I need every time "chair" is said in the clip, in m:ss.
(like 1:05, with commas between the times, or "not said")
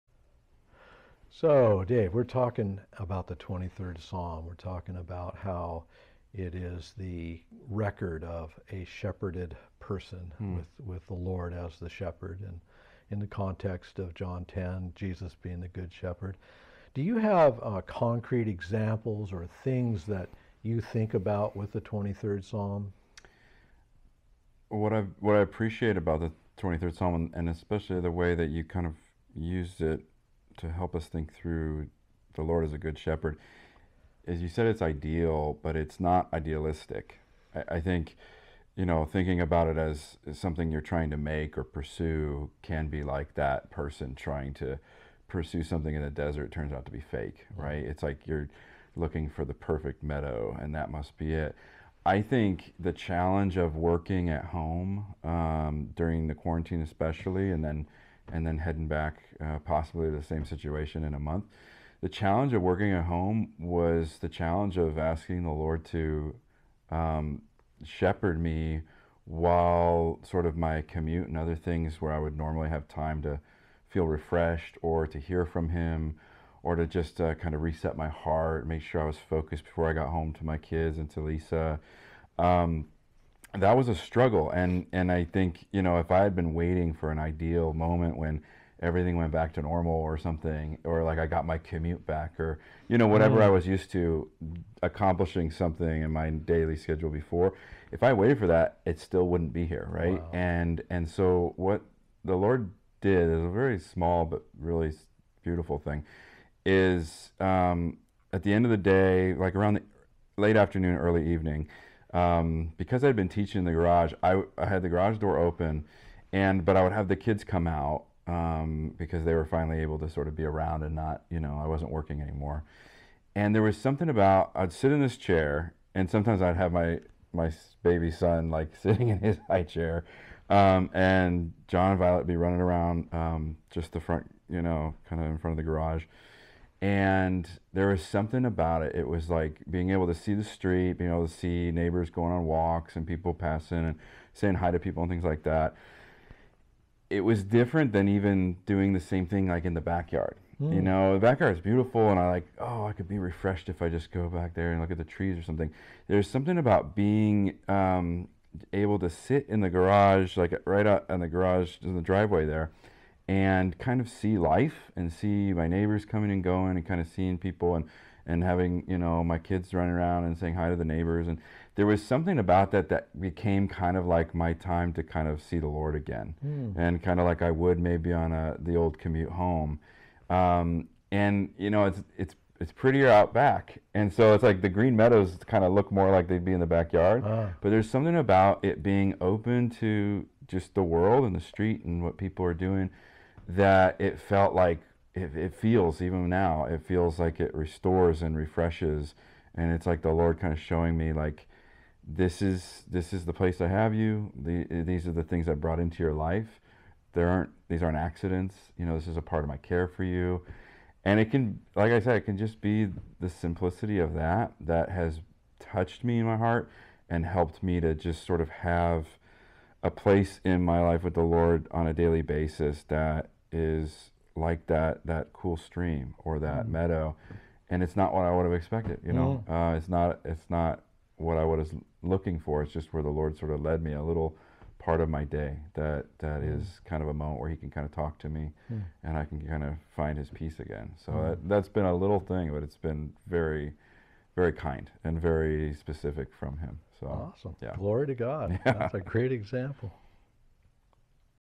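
2:05, 2:09.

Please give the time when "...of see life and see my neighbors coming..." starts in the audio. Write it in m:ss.
2:44.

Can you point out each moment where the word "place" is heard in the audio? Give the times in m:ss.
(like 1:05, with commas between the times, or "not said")
3:23, 3:39.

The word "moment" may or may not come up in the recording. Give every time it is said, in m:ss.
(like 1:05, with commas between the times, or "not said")
1:27, 3:57.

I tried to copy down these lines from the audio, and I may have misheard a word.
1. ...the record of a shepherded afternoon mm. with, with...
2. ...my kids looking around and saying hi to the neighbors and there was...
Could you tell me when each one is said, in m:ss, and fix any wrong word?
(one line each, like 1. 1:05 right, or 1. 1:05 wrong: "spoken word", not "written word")
1. 0:06 wrong: "person", not "afternoon"
2. 2:49 wrong: "running", not "looking".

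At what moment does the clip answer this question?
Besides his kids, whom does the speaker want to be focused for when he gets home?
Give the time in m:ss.
1:21.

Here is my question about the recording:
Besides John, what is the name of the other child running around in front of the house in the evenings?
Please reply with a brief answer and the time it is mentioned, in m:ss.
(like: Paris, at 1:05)
Violet, at 2:11.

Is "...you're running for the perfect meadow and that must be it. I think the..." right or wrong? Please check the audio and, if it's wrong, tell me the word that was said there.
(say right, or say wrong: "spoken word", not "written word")
wrong: "looking", not "running".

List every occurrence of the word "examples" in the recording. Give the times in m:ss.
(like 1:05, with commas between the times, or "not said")
0:18, 4:09.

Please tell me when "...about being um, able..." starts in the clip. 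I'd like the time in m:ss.
2:36.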